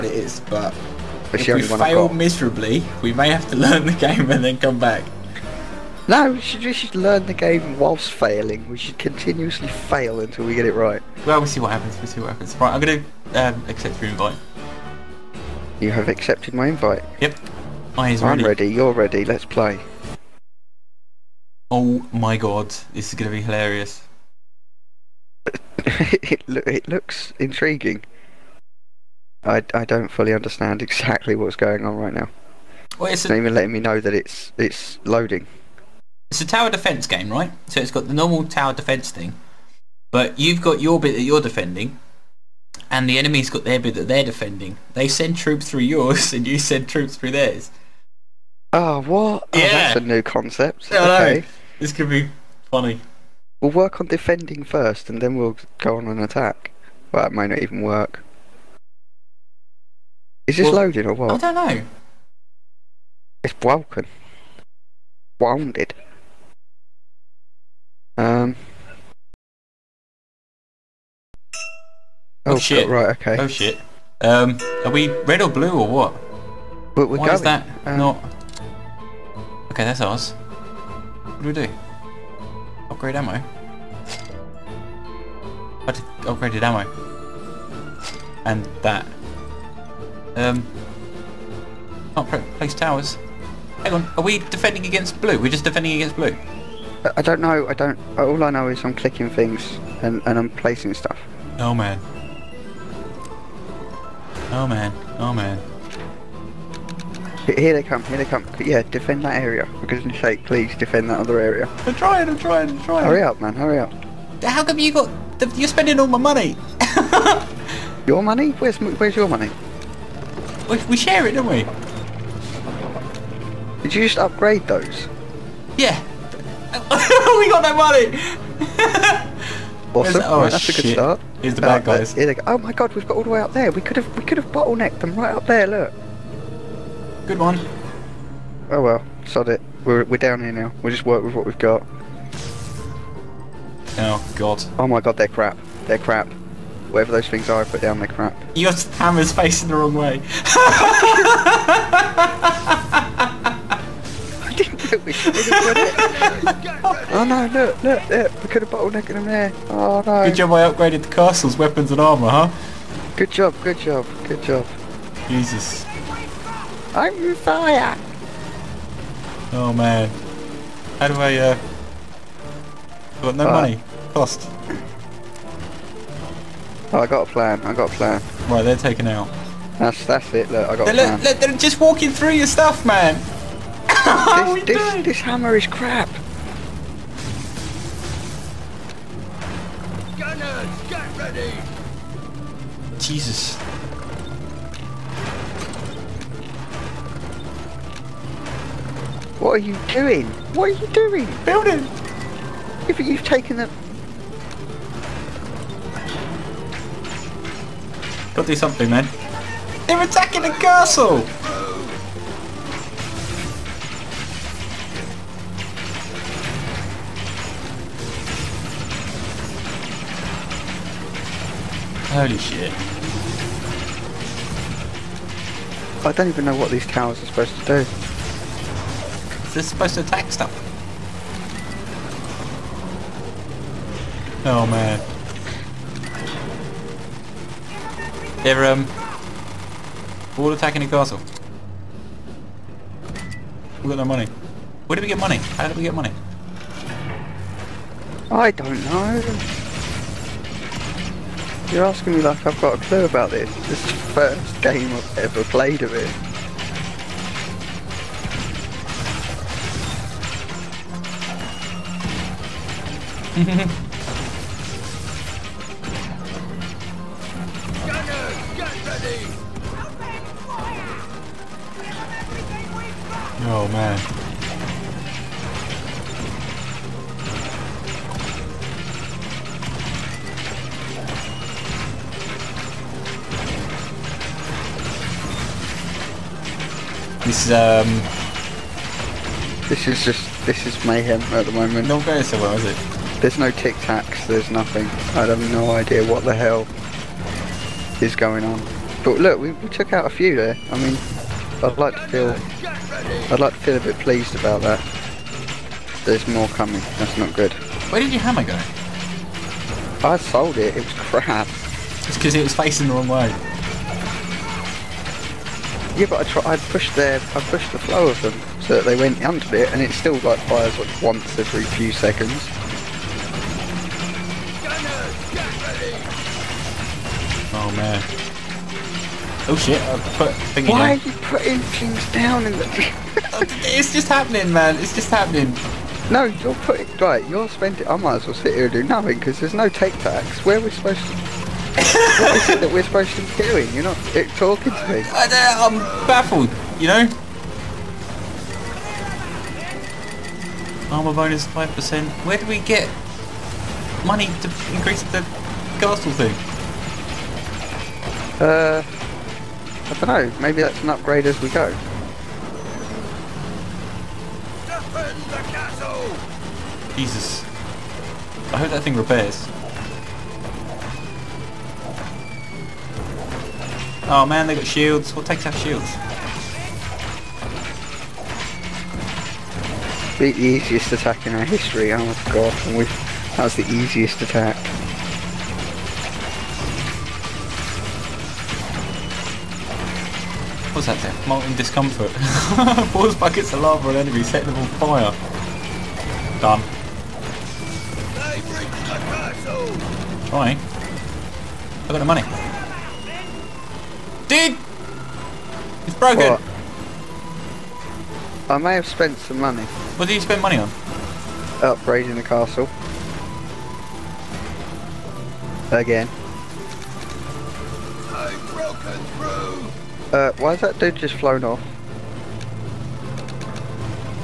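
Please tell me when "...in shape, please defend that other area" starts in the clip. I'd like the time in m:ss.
1:50.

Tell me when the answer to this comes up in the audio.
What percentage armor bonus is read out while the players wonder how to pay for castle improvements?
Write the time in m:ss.
5:50.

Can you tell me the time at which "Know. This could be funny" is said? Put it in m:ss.
0:51.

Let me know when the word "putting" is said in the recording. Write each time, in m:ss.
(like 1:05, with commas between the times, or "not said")
5:31, 5:36.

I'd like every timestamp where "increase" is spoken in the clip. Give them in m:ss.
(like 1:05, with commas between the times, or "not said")
5:54.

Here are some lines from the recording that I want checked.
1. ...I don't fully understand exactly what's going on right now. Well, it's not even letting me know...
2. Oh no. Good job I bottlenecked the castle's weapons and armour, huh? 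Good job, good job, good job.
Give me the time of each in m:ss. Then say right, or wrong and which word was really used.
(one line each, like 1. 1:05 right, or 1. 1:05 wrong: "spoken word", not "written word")
1. 0:29 right
2. 2:39 wrong: "upgraded", not "bottlenecked".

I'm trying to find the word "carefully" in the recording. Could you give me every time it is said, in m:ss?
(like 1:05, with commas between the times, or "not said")
not said.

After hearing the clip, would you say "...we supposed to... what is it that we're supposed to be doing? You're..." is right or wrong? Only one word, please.
right.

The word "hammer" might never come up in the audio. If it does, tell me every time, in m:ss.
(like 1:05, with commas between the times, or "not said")
2:28, 3:05, 5:08.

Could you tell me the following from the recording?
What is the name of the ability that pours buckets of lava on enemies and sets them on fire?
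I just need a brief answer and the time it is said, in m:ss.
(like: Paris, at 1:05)
Molten discomfort, at 6:31.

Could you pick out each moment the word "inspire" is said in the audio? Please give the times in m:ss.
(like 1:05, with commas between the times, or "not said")
not said.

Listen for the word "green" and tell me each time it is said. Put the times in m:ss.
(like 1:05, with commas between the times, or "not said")
not said.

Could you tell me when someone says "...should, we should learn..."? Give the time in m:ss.
0:06.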